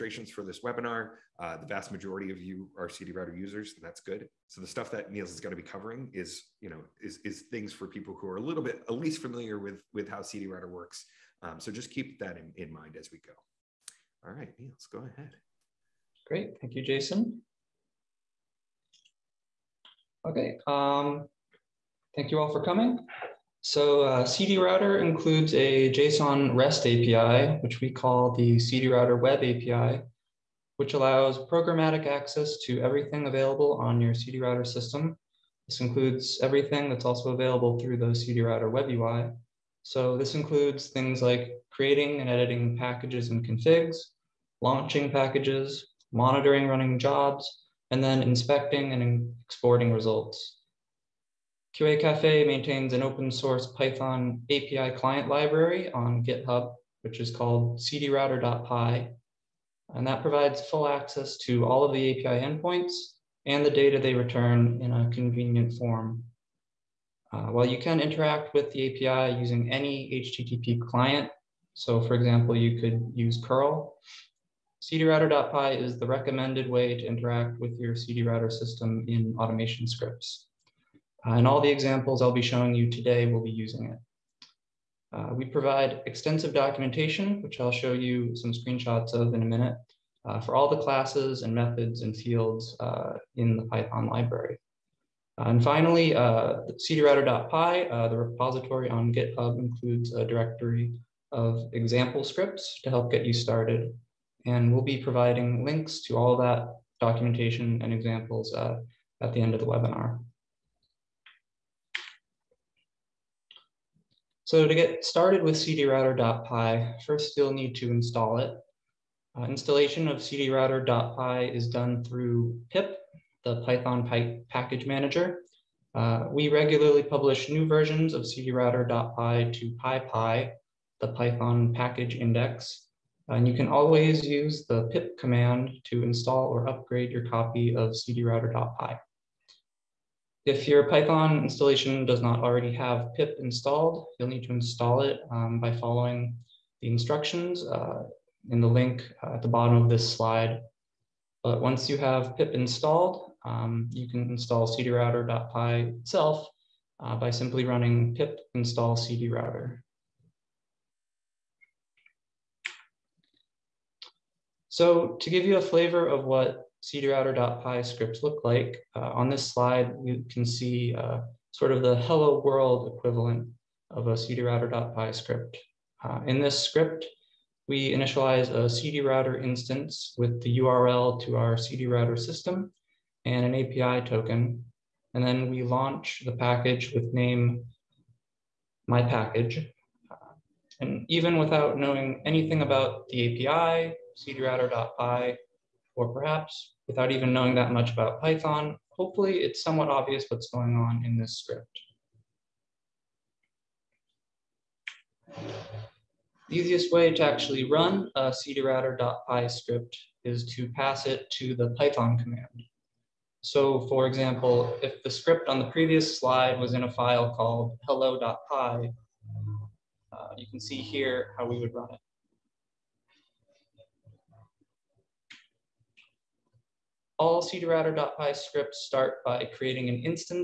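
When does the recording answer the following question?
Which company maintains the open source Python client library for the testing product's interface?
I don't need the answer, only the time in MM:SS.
00:51.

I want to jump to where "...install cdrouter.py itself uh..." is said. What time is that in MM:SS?
02:34.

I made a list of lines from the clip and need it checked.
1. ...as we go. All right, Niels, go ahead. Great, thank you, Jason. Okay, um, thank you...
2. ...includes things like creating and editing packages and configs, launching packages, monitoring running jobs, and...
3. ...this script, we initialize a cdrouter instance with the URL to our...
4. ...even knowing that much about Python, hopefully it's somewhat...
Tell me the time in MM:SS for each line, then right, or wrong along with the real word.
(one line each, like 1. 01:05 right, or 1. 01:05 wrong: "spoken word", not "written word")
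1. 00:12 right
2. 00:40 right
3. 02:56 right
4. 03:17 right.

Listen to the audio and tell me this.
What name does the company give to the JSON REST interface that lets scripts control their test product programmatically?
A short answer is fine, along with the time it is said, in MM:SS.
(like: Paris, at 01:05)
CD router web API, at 00:28.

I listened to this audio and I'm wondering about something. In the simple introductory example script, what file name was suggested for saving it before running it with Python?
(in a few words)
hello.py.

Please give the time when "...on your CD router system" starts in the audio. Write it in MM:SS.
00:33.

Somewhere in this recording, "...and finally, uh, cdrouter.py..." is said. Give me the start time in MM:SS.
01:35.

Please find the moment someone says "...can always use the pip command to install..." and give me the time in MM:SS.
02:13.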